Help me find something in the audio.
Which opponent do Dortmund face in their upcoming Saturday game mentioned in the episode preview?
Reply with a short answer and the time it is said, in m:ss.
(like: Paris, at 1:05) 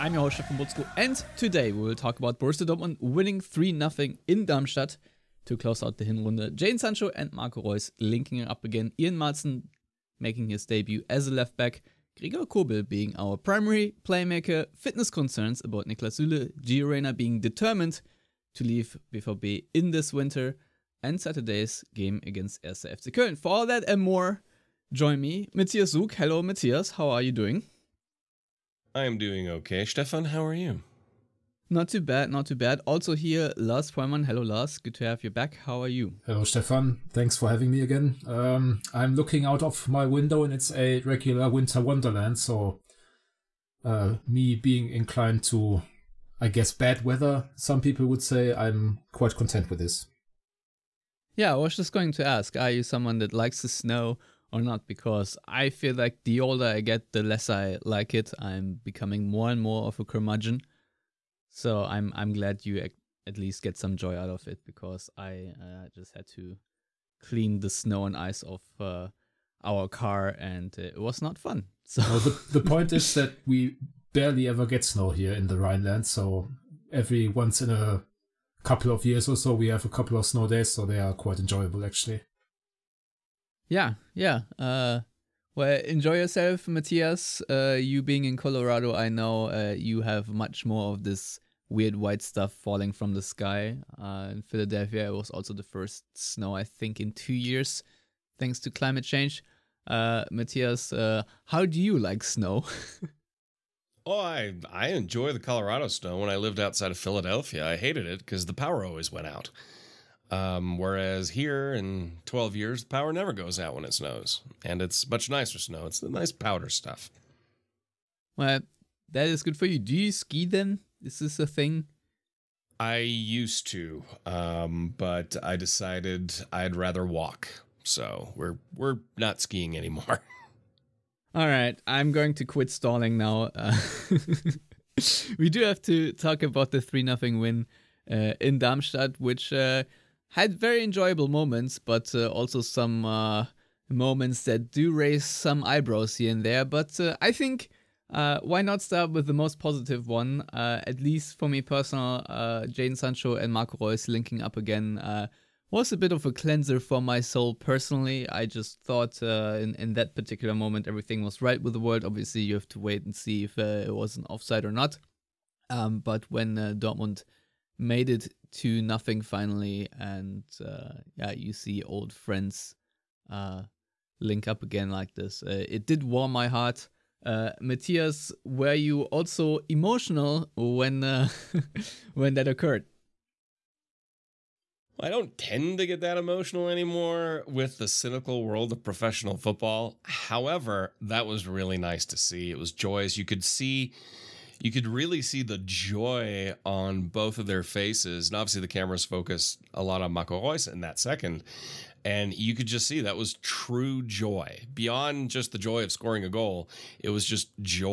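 1. FC Köln, at 0:22.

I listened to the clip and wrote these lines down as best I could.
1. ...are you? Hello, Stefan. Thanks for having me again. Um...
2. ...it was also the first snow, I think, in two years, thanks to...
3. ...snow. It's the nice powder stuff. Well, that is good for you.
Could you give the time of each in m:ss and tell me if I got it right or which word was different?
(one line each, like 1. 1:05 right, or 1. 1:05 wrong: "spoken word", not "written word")
1. 0:35 right
2. 1:35 right
3. 1:55 right.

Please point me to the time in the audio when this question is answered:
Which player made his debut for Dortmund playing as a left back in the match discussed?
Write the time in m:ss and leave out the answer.
0:08.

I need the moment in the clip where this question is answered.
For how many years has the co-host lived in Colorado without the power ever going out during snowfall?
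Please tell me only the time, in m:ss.
1:52.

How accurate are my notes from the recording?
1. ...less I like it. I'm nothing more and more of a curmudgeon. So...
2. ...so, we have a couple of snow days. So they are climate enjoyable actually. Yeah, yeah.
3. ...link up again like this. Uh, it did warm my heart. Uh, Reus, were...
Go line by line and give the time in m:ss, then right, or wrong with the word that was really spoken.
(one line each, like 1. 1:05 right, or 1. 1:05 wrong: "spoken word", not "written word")
1. 0:57 wrong: "becoming", not "nothing"
2. 1:19 wrong: "quite", not "climate"
3. 2:54 wrong: "Matthias", not "Reus".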